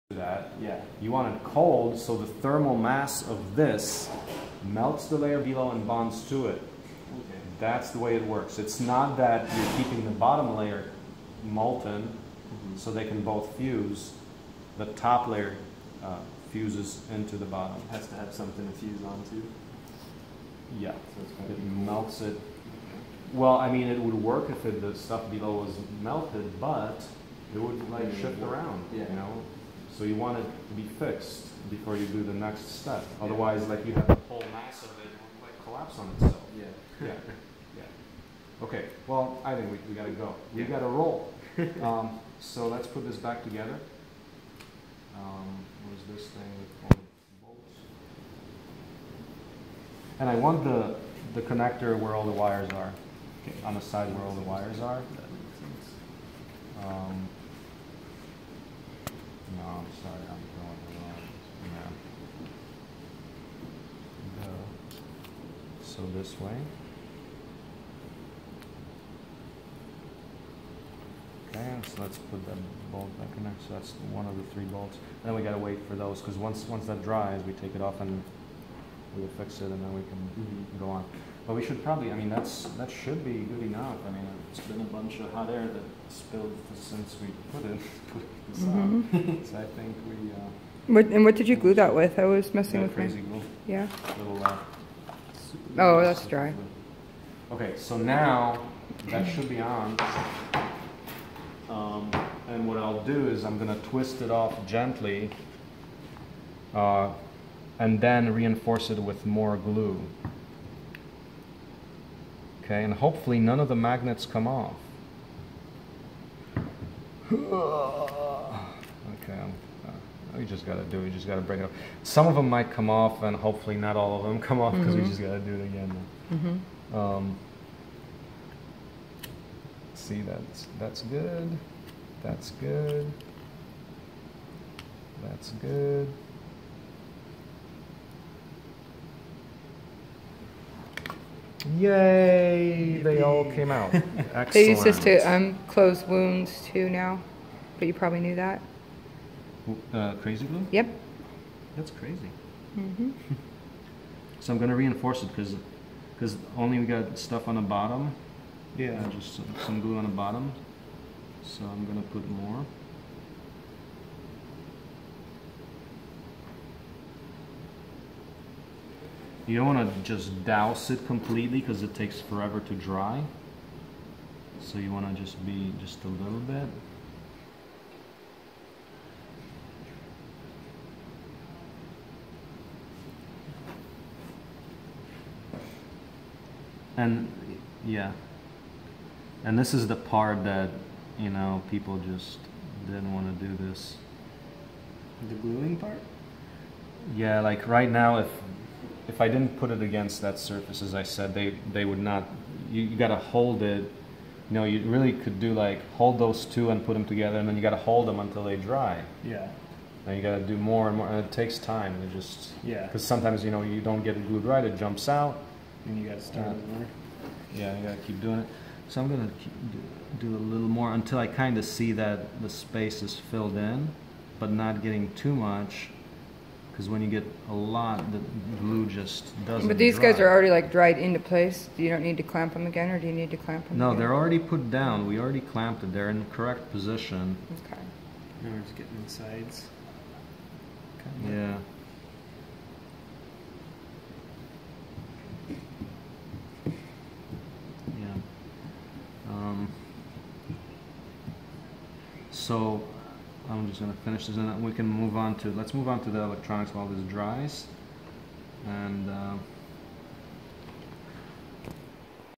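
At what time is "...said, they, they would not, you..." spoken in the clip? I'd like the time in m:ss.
3:21.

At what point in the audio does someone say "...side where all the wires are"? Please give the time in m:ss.
0:53.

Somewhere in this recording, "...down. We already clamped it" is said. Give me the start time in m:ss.
3:54.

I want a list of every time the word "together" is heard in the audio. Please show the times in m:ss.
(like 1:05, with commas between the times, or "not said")
0:43, 3:27.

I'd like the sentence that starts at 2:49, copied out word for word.
You don't want to just douse it completely because it takes forever to dry.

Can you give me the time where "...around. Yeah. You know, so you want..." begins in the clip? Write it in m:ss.
0:28.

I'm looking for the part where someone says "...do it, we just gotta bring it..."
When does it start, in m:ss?
2:00.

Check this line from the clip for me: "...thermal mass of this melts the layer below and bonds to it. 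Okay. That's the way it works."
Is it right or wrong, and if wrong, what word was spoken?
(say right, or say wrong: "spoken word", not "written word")
right.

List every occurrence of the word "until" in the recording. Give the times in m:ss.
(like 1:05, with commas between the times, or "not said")
3:28, 3:40.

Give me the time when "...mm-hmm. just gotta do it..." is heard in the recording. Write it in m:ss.
2:05.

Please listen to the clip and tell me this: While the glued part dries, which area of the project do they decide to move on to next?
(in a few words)
The electronics.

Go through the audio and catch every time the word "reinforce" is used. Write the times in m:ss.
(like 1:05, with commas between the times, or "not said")
1:48, 2:34.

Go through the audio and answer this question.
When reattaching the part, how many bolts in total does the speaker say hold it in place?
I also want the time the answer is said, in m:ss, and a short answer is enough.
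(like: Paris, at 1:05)
3, at 1:14.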